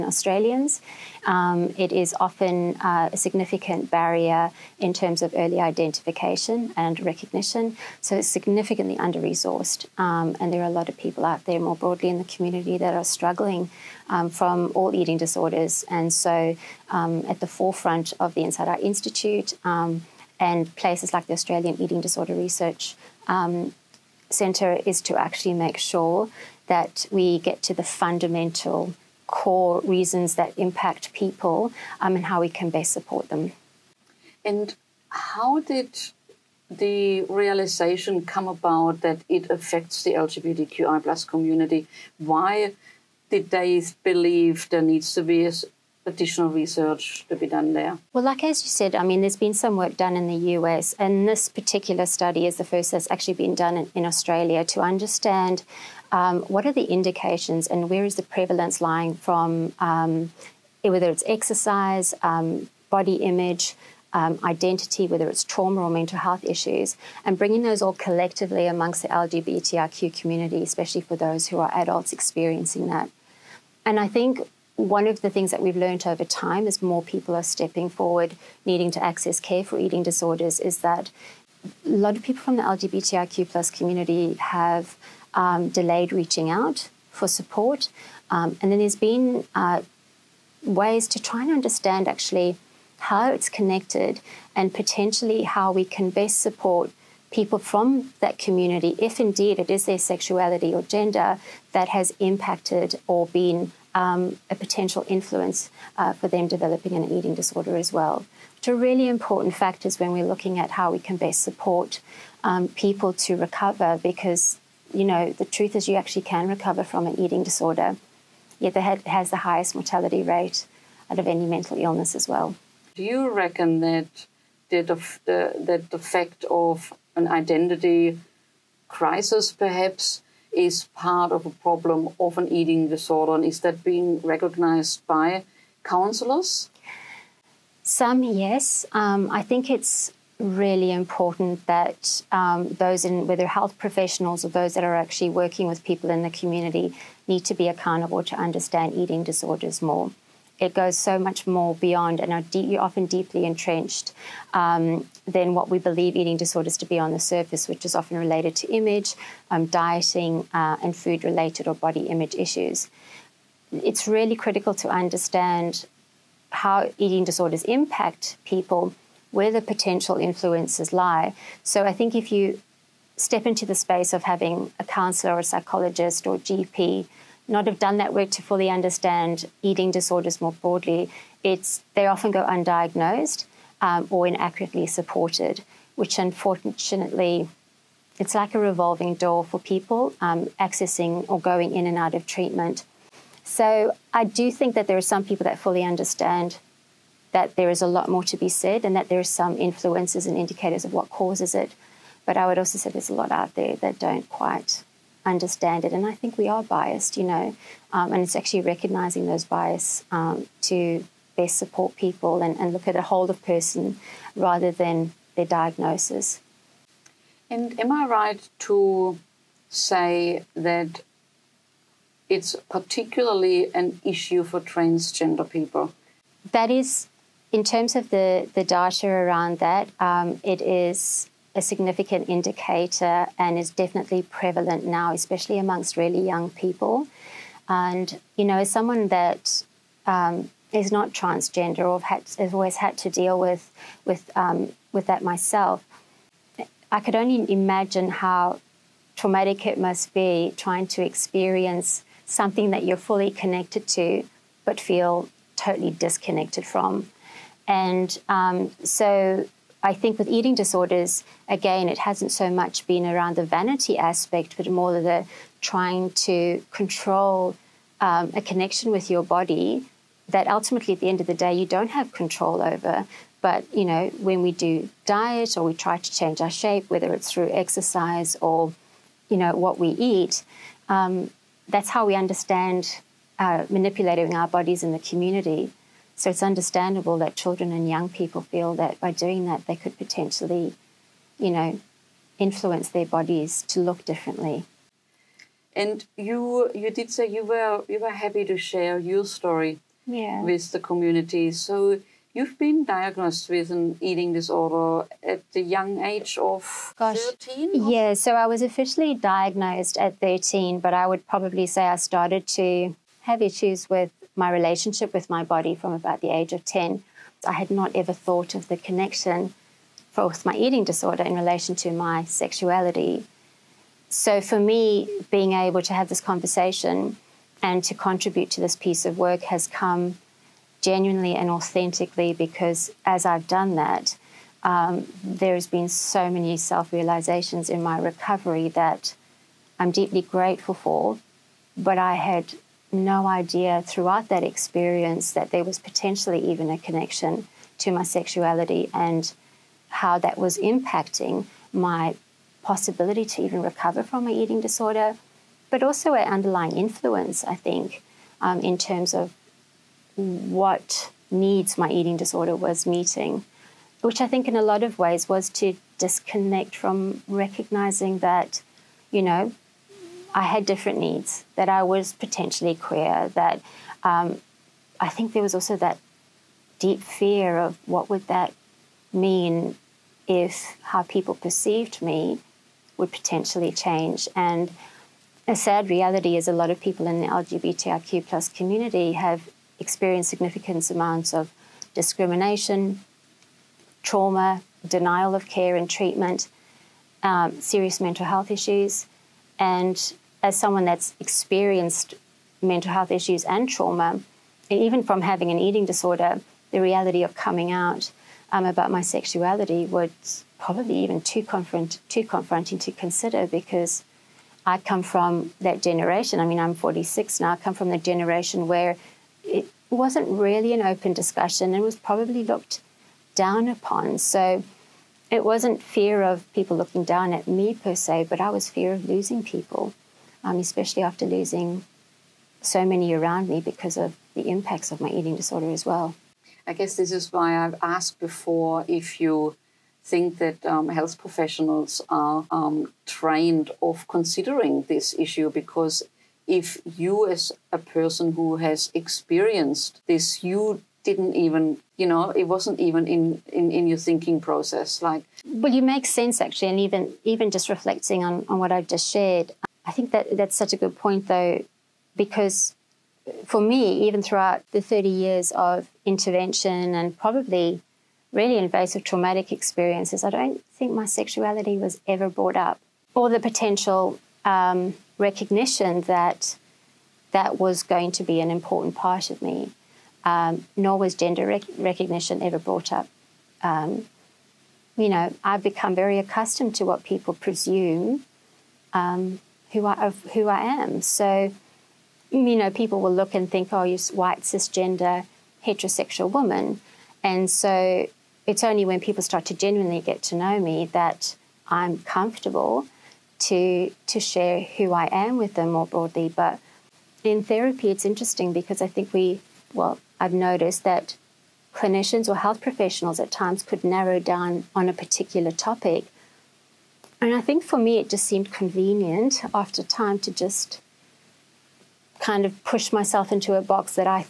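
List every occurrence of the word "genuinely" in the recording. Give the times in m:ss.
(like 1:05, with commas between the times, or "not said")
5:30, 8:19.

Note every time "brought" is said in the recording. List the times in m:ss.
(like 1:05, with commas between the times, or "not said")
7:52, 8:02.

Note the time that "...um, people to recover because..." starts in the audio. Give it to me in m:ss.
1:52.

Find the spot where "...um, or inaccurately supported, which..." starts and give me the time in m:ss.
3:03.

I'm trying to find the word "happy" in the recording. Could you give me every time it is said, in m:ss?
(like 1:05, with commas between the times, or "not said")
4:58.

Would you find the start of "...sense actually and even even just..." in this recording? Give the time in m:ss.
7:36.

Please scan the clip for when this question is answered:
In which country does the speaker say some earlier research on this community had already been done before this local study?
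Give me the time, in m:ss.
0:50.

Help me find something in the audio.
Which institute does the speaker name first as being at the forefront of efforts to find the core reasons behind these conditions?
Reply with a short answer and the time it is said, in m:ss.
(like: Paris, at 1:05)
Inside Out Institute, at 0:18.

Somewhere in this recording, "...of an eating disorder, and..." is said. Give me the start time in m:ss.
2:12.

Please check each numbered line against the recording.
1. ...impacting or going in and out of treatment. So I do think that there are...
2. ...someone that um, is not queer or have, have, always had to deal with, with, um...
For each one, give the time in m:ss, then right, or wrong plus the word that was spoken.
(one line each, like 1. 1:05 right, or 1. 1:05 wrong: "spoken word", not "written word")
1. 3:10 wrong: "accessing", not "impacting"
2. 3:58 wrong: "transgender", not "queer".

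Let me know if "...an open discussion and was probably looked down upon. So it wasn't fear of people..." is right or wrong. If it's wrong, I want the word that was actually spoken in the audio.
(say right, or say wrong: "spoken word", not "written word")
right.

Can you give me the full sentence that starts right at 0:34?
And how did the realization come about that it affects the LGBTQI plus community?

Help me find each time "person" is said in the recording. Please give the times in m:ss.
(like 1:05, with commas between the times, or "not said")
3:33, 7:27.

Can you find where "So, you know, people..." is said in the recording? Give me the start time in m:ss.
8:11.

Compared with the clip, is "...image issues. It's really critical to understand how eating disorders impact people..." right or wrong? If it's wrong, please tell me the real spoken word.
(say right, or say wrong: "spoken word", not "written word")
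right.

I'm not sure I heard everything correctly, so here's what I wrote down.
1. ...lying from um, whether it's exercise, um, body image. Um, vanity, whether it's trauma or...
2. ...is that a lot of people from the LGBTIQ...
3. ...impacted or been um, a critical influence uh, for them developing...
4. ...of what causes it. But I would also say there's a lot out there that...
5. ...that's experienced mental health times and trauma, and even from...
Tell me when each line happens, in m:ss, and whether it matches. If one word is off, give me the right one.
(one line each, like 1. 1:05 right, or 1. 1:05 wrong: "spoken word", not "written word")
1. 0:58 wrong: "identity", not "vanity"
2. 1:20 right
3. 1:42 wrong: "potential", not "critical"
4. 3:20 right
5. 6:40 wrong: "issues", not "times".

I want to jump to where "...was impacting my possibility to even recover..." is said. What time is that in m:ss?
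5:50.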